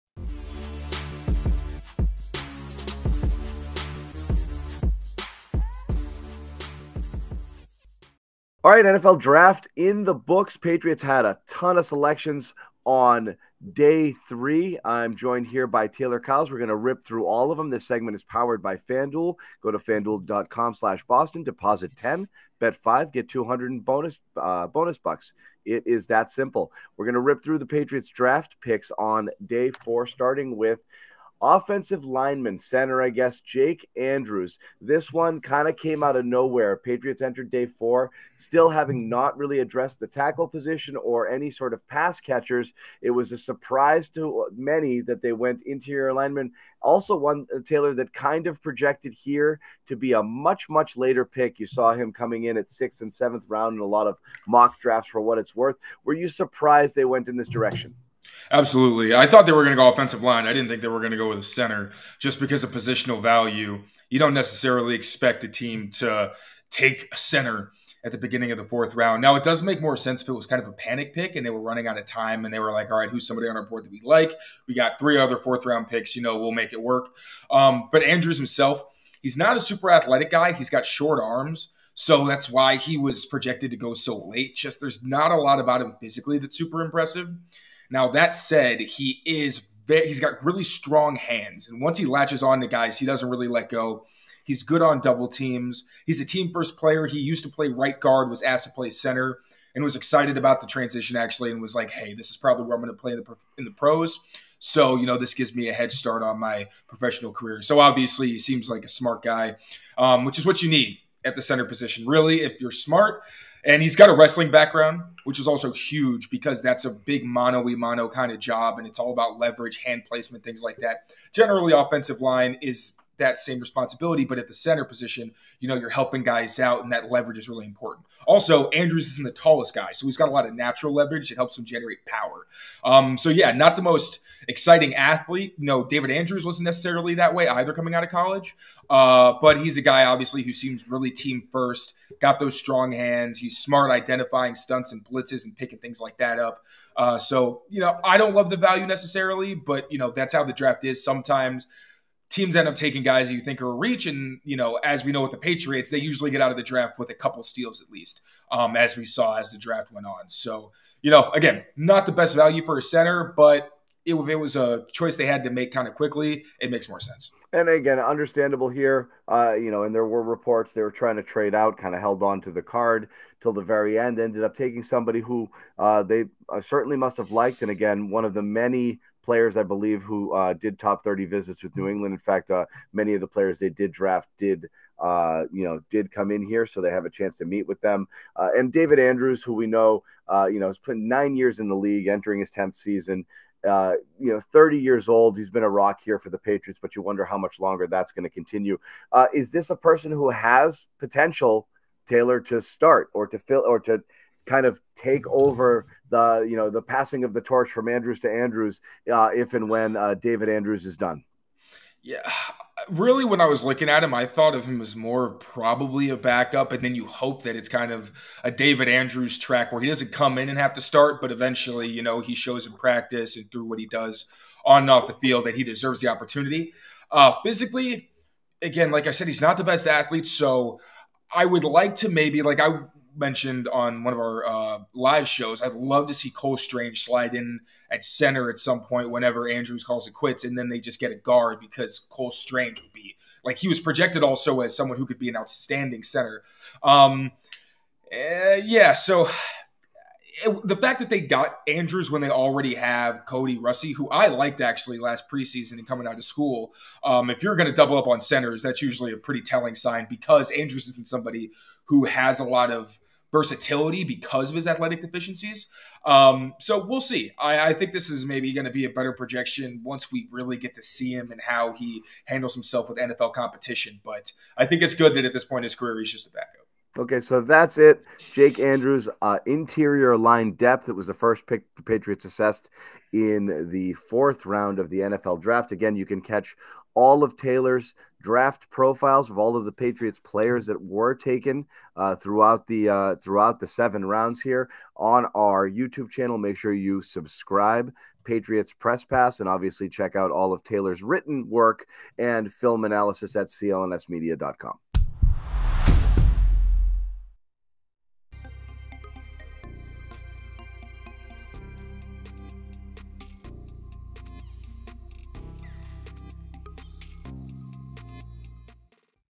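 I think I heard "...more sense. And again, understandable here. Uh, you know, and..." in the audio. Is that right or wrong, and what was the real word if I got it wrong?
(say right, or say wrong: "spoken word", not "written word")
right.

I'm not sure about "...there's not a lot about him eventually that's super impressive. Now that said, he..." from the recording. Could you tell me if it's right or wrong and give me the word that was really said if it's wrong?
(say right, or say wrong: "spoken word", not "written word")
wrong: "physically", not "eventually".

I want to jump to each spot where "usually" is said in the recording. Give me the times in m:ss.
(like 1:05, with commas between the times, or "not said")
2:35, 4:18.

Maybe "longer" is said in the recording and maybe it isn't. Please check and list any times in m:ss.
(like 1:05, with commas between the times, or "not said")
3:17.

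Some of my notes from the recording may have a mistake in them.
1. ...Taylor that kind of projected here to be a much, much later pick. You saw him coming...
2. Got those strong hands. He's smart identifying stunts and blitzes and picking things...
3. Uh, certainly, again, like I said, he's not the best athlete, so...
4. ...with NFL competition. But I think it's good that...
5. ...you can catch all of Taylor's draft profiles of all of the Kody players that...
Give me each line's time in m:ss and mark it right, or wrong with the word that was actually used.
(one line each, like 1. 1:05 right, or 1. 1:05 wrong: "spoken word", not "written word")
1. 0:47 right
2. 2:22 right
3. 3:47 wrong: "physically", not "certainly"
4. 4:32 right
5. 4:45 wrong: "Patriots", not "Kody".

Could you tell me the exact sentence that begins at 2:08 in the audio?
Also, Andrews isn't the tallest guy, so he's got a lot of natural leverage.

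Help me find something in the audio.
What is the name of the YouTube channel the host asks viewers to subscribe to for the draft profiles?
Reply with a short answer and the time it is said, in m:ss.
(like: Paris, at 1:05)
Patriots Press Pass, at 4:58.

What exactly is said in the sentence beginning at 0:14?
I'm joined here by Taylor Kyles.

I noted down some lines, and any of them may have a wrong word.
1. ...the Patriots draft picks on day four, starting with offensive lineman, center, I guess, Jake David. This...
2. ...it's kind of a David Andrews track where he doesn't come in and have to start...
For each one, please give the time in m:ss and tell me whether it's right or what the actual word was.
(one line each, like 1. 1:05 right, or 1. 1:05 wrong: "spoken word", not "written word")
1. 0:27 wrong: "Andrews", not "David"
2. 3:37 right.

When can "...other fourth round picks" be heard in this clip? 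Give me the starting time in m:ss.
1:15.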